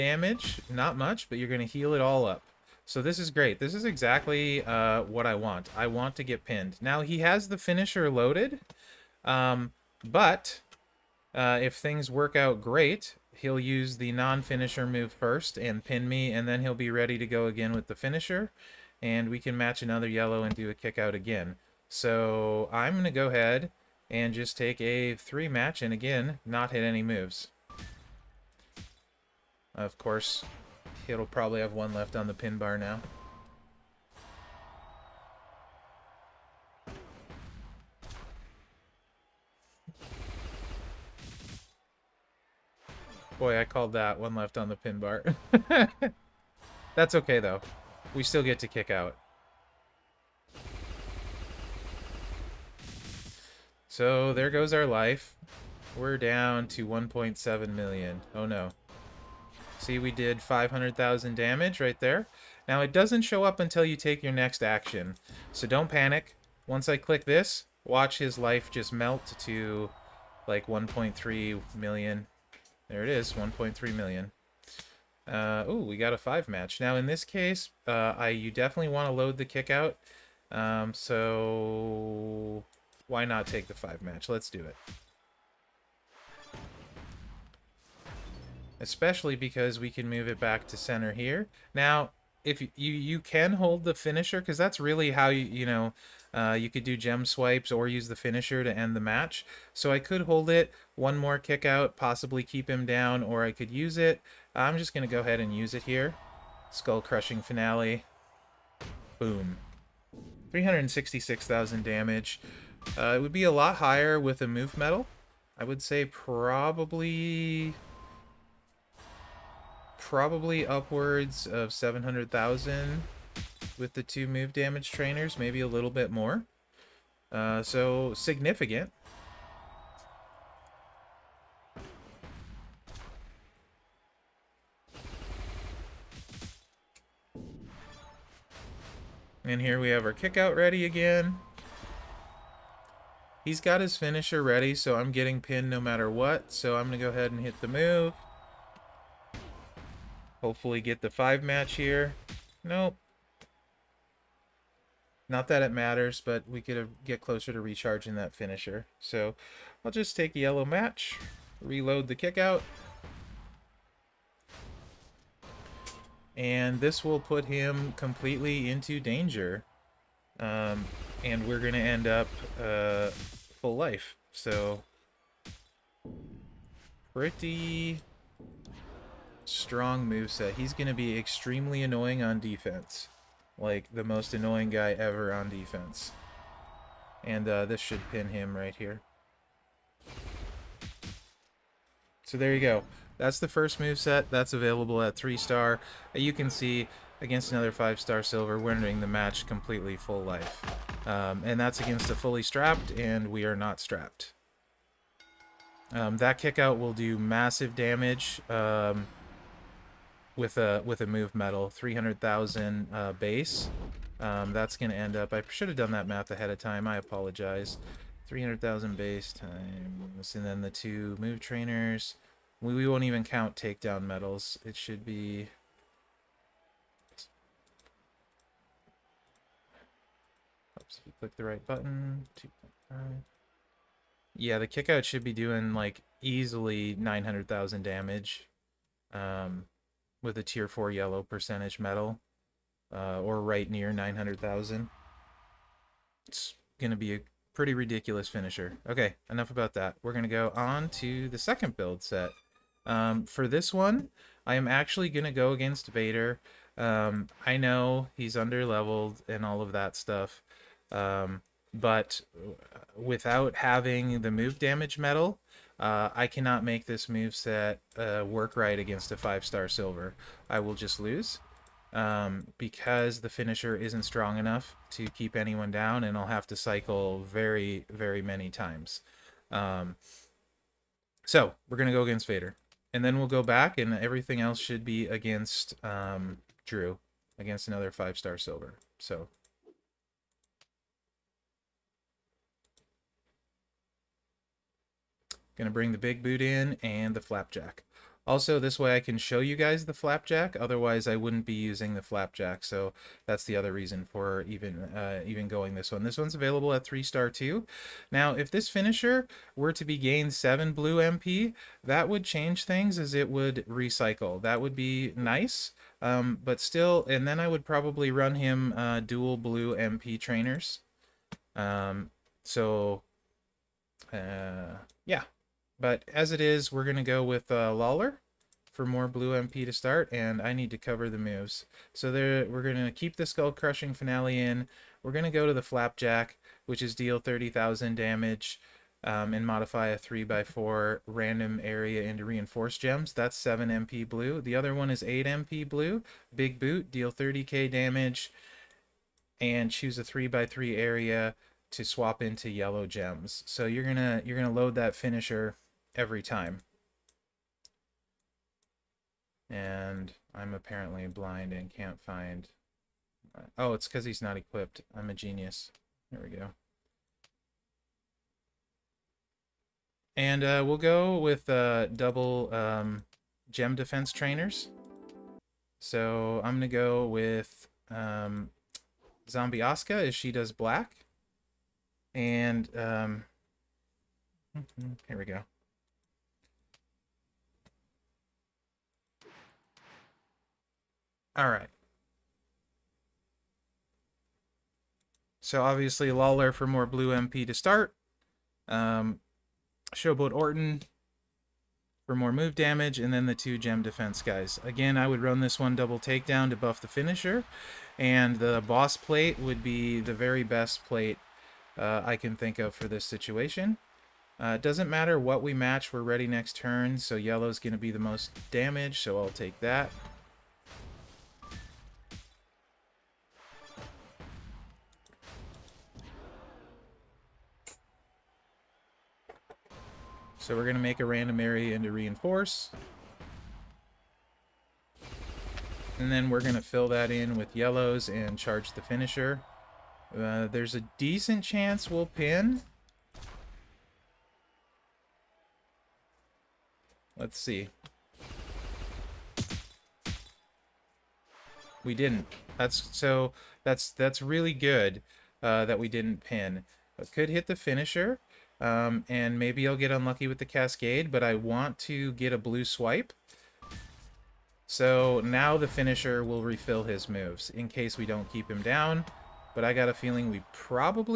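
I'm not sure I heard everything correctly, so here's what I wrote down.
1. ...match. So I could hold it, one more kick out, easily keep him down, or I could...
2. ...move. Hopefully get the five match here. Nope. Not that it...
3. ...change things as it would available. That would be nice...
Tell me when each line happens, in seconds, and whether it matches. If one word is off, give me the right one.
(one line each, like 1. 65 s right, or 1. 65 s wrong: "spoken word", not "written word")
1. 99 s wrong: "possibly", not "easily"
2. 147 s right
3. 312 s wrong: "recycle", not "available".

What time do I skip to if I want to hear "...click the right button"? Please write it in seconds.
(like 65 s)
231 s.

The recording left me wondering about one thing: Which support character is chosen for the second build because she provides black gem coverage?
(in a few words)
Zombie Asuka.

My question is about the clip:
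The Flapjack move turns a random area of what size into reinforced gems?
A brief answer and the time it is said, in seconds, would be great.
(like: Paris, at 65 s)
3x4, at 339 s.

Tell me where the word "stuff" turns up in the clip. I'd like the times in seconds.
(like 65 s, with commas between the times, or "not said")
259 s.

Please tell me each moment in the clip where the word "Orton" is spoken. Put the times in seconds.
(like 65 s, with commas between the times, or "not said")
400 s.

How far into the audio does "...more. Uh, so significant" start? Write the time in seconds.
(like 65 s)
126 s.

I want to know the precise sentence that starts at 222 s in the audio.
We, we won't even count takedown medals.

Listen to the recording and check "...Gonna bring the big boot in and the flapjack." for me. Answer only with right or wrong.
right.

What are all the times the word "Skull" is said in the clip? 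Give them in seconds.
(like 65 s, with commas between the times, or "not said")
106 s, 333 s.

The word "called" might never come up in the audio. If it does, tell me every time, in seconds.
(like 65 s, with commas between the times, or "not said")
43 s.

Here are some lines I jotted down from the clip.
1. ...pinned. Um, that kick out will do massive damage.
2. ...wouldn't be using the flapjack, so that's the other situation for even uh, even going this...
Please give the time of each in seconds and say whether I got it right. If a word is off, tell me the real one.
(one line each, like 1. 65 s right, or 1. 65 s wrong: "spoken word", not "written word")
1. 203 s wrong: "strapped", not "pinned"
2. 301 s wrong: "reason", not "situation".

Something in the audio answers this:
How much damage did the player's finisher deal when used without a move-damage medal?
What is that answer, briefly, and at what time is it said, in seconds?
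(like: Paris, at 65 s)
366,000, at 110 s.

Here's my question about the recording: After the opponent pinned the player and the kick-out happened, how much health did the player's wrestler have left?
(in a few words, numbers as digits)
1.7 million.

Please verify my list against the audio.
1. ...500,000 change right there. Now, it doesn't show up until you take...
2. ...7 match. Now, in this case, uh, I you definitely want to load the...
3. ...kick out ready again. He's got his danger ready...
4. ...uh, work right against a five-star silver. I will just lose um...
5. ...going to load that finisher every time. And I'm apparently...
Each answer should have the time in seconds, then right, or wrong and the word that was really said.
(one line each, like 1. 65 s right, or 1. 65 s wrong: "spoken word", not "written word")
1. 60 s wrong: "damage", not "change"
2. 76 s wrong: "5", not "7"
3. 140 s wrong: "finisher", not "danger"
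4. 267 s right
5. 354 s right.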